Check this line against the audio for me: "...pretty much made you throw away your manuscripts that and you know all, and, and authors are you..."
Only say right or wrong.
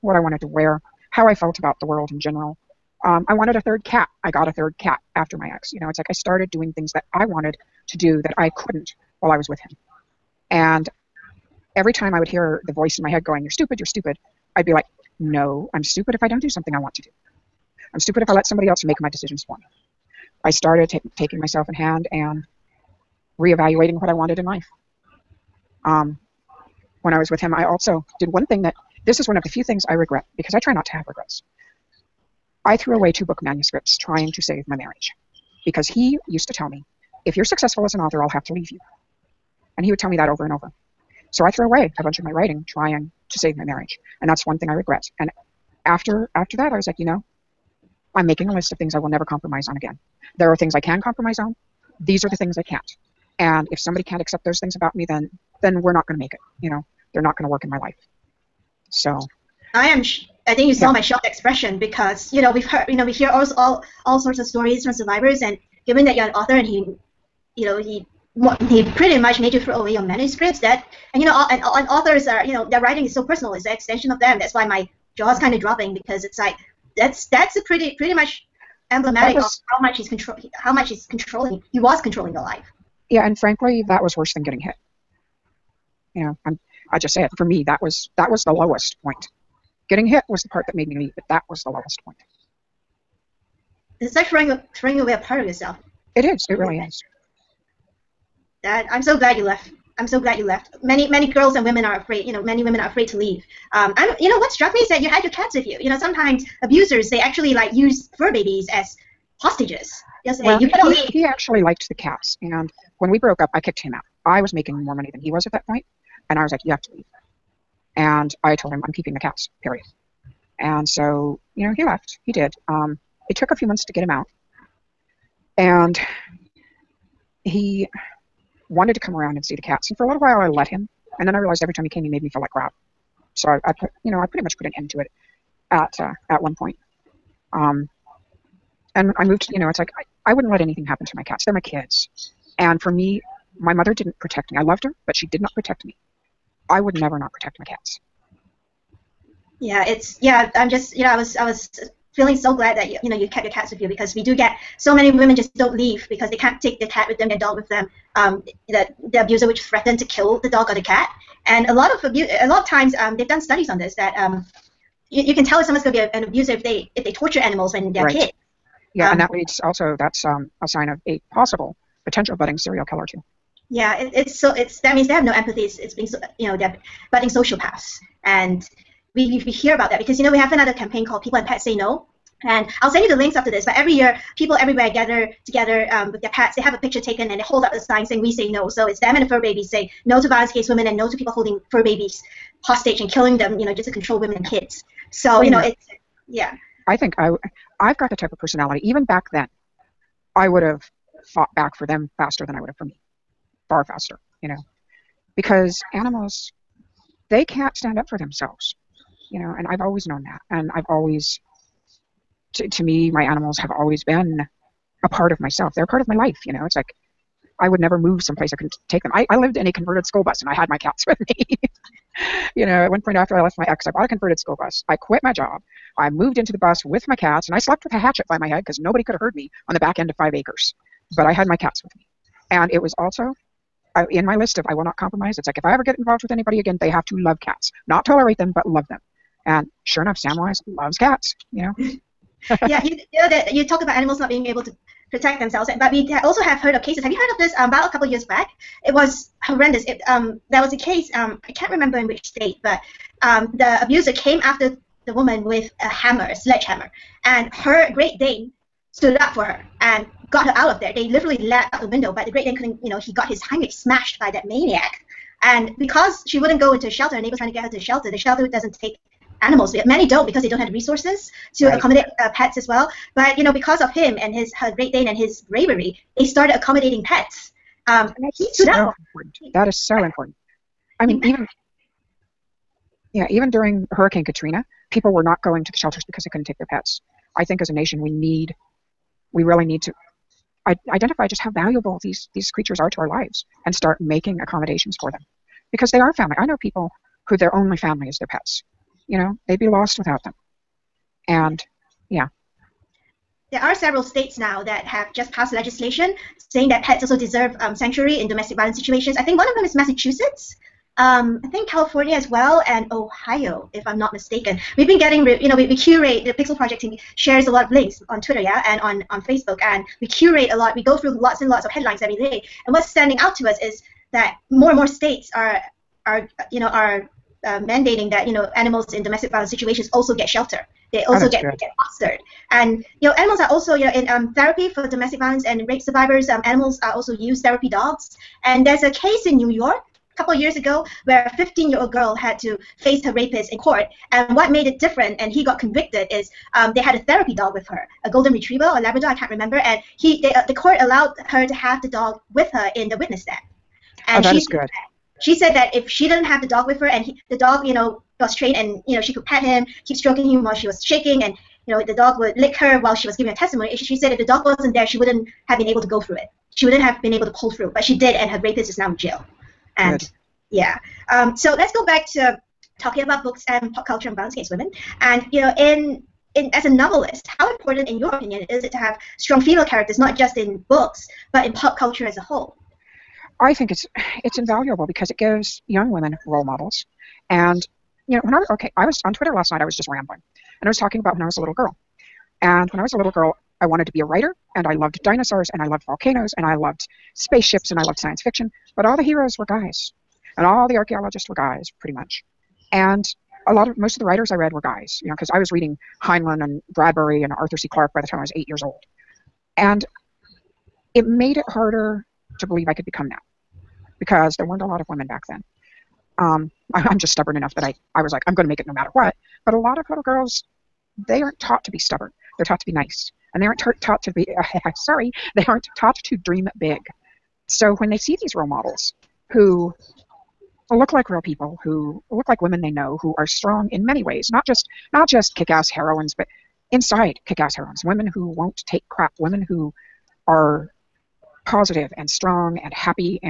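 right.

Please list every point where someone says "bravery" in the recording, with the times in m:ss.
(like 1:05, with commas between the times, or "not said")
4:35.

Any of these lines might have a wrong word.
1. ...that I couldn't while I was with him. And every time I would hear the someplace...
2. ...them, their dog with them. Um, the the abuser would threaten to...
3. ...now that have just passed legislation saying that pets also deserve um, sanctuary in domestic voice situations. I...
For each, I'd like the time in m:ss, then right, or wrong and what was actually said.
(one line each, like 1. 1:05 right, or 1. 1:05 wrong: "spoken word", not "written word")
1. 0:08 wrong: "voice", not "someplace"
2. 2:37 right
3. 5:04 wrong: "violence", not "voice".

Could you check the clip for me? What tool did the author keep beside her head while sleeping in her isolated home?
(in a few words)
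hatchet.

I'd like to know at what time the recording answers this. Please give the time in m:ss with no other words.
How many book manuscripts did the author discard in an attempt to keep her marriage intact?
0:33.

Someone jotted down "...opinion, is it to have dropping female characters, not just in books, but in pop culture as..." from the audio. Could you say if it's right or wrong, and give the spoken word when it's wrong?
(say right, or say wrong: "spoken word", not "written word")
wrong: "strong", not "dropping".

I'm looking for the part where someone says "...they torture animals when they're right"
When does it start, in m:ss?
2:47.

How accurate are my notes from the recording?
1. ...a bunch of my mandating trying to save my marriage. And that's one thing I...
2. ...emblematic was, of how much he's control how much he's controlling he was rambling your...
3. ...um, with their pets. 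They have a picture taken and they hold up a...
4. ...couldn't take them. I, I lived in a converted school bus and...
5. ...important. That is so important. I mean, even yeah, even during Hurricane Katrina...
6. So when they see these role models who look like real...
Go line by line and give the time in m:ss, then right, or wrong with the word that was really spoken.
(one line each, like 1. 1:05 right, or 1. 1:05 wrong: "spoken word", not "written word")
1. 0:41 wrong: "writing", not "mandating"
2. 1:18 wrong: "controlling", not "rambling"
3. 3:05 right
4. 3:38 right
5. 4:38 right
6. 7:07 right.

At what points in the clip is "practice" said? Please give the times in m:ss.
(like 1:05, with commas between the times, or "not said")
not said.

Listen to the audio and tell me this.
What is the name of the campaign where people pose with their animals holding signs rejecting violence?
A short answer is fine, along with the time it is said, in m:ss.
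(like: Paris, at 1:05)
People and Pets Say No, at 3:01.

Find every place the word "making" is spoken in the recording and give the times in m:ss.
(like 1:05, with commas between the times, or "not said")
0:48, 1:54, 4:53.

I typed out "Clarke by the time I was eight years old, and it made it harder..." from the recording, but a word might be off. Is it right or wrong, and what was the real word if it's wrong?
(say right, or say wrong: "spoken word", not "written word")
right.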